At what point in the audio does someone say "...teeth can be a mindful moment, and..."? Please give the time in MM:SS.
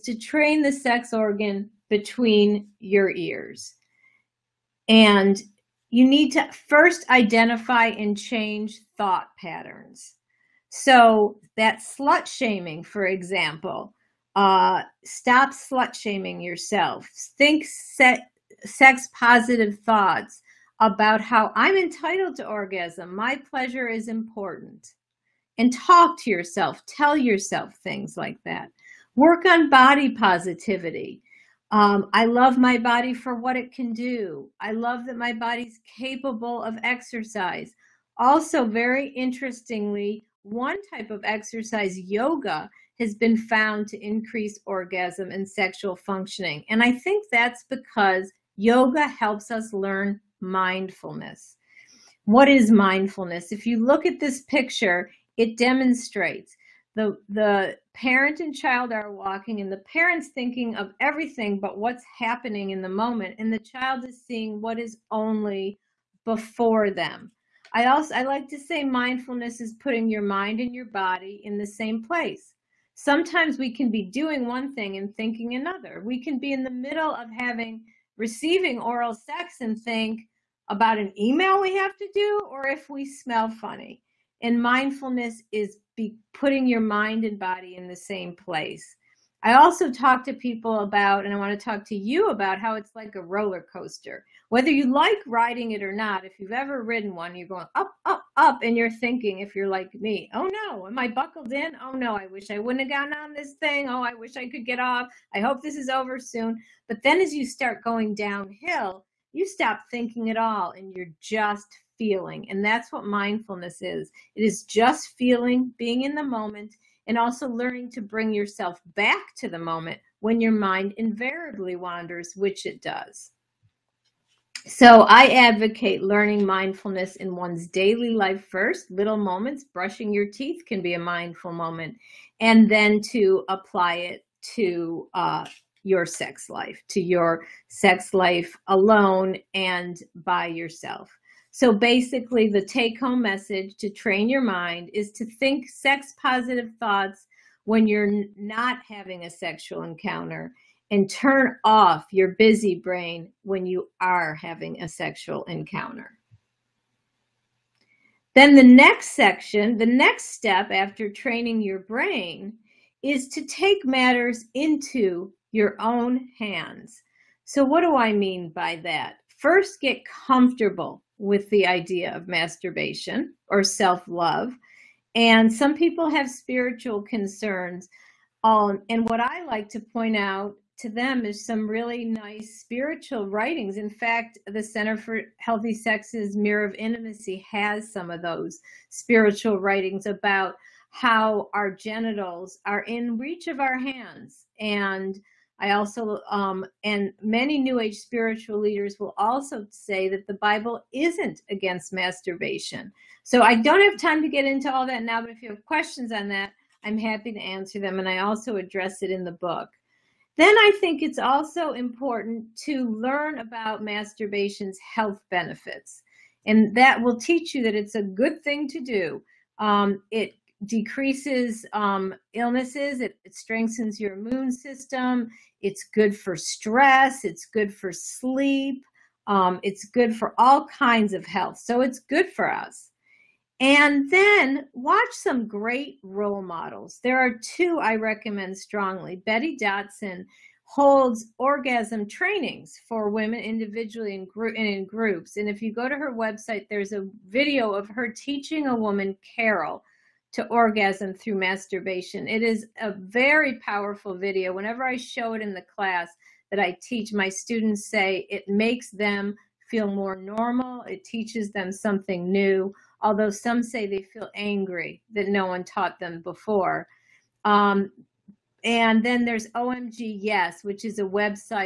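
02:10.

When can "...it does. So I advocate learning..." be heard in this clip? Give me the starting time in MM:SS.
02:02.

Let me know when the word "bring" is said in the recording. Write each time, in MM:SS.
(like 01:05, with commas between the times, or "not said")
01:57.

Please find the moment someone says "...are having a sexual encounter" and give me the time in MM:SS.
02:34.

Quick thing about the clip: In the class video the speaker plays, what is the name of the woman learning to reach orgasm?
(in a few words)
Carol.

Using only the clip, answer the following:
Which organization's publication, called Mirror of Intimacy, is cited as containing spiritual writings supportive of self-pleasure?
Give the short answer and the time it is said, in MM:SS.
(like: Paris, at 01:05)
Center for Healthy Sex, at 03:04.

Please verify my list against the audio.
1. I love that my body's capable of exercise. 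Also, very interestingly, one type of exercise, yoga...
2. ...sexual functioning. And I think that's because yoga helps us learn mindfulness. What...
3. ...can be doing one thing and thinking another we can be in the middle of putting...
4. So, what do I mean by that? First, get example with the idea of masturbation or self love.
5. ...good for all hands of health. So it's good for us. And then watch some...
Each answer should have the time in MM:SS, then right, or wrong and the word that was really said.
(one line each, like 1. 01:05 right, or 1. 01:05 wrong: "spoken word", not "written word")
1. 00:34 right
2. 00:45 right
3. 01:13 wrong: "having", not "putting"
4. 02:47 wrong: "comfortable", not "example"
5. 03:49 wrong: "kinds", not "hands".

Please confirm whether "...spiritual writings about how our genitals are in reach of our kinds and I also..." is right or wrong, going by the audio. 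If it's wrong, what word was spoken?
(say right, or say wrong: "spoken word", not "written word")
wrong: "hands", not "kinds".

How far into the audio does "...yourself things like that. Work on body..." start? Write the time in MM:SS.
00:27.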